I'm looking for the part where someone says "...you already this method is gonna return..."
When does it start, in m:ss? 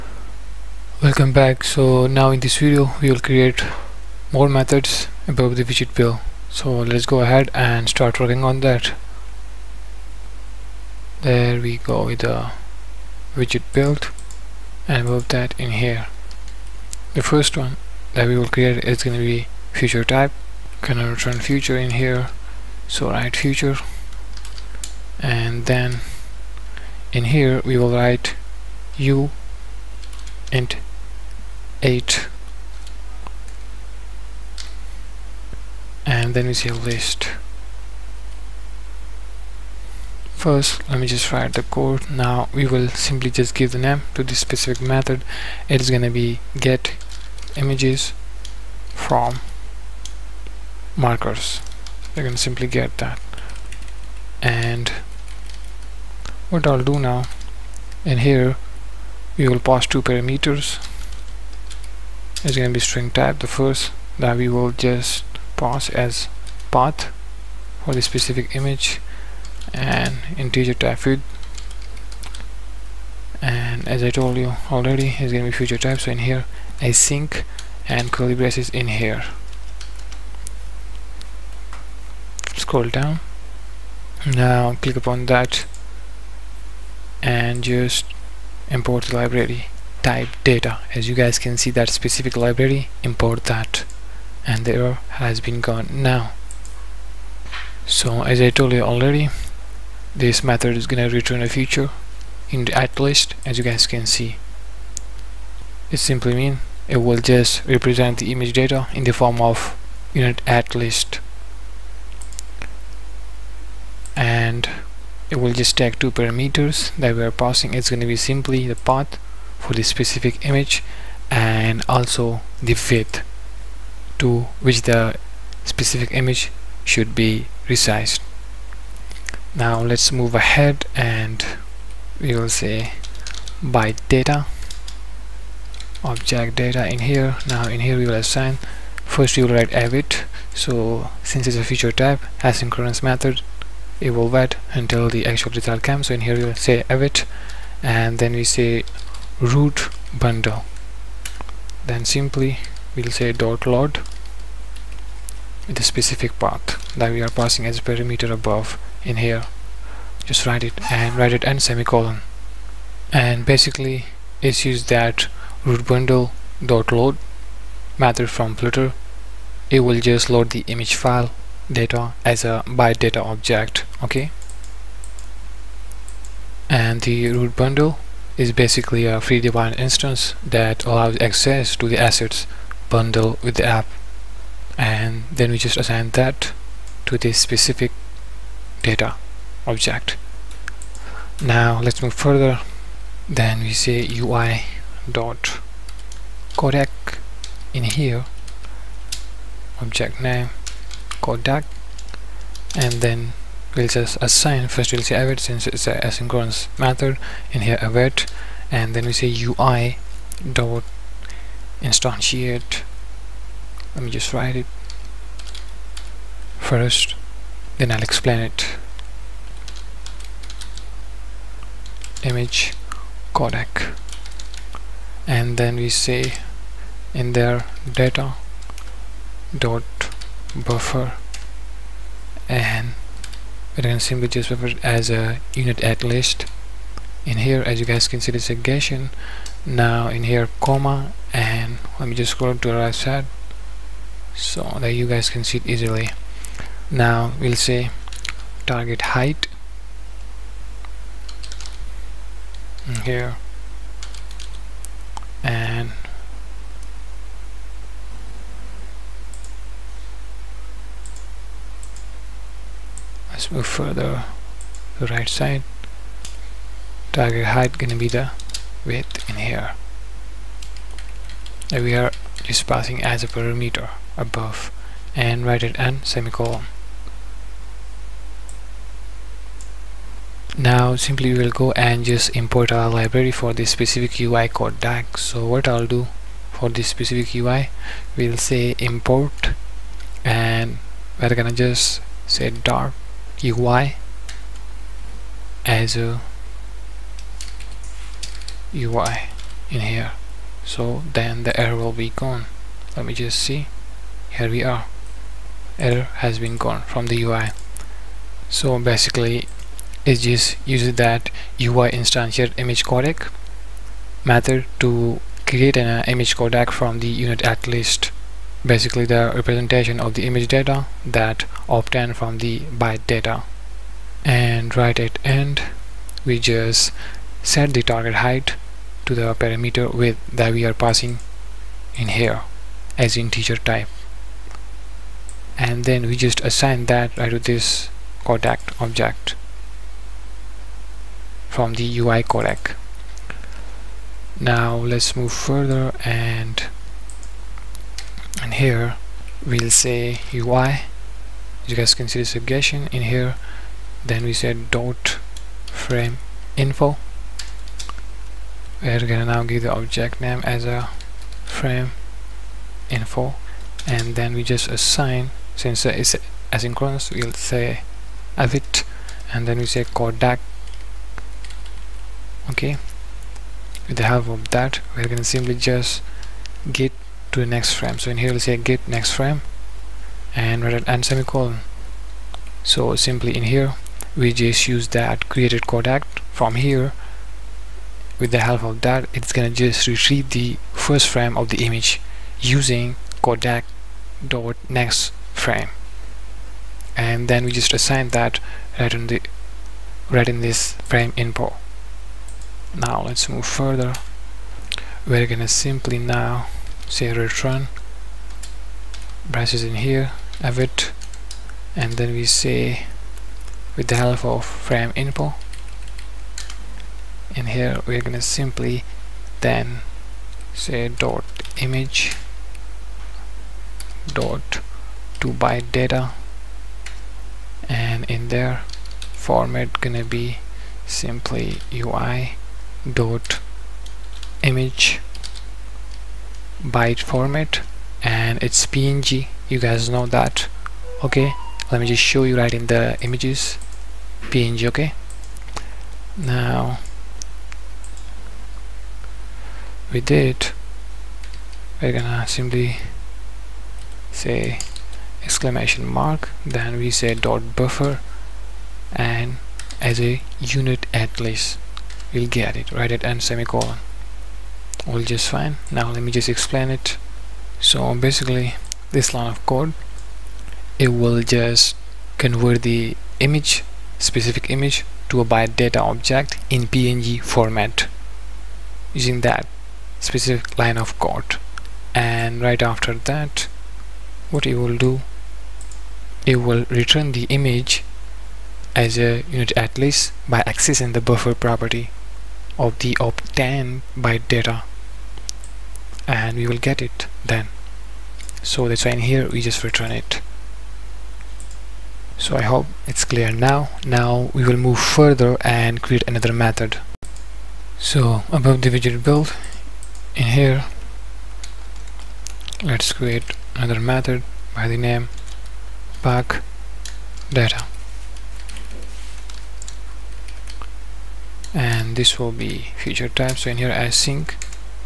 1:38.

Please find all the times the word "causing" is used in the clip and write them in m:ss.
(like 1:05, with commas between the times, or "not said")
not said.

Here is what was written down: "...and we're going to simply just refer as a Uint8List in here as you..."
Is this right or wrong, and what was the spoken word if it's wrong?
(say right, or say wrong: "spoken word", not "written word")
right.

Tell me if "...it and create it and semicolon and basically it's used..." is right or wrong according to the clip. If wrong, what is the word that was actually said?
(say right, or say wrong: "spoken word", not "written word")
wrong: "write", not "create".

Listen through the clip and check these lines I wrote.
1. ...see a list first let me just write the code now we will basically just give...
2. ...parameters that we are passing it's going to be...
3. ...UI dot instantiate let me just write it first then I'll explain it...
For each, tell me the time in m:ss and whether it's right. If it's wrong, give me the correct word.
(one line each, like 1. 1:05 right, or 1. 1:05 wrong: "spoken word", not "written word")
1. 0:36 wrong: "simply", not "basically"
2. 1:56 right
3. 3:29 right.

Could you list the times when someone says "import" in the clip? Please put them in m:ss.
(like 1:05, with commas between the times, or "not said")
1:28, 1:33, 4:42, 4:48.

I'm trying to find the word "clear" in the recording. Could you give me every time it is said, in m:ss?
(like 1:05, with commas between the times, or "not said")
8:23.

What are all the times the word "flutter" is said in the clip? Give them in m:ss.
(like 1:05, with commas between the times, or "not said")
2:48.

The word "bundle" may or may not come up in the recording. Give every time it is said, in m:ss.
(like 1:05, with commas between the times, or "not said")
2:30, 2:45, 2:57, 3:02.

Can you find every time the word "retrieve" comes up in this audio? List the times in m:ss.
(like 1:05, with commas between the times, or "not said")
6:29.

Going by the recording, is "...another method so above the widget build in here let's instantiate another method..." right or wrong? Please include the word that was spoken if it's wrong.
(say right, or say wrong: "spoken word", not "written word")
wrong: "create", not "instantiate".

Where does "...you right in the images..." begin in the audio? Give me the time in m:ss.
7:22.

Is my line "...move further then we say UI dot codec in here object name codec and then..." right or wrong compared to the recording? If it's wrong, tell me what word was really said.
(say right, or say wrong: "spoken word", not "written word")
right.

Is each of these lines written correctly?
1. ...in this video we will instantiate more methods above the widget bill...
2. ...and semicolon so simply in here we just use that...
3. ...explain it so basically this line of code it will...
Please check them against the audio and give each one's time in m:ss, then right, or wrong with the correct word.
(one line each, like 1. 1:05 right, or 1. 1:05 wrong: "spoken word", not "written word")
1. 0:02 wrong: "create", not "instantiate"
2. 6:20 right
3. 7:46 right.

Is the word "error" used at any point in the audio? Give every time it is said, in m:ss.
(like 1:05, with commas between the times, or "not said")
1:34, 5:01, 5:05.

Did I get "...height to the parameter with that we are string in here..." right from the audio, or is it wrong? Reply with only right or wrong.
wrong.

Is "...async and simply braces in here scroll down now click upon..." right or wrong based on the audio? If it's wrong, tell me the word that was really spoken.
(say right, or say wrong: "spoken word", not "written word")
wrong: "curly", not "simply".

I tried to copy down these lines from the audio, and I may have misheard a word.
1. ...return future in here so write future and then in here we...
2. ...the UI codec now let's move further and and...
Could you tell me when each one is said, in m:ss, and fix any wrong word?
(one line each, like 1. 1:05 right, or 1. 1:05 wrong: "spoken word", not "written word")
1. 0:21 right
2. 5:41 right.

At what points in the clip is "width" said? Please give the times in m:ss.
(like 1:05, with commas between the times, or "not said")
2:02, 4:28.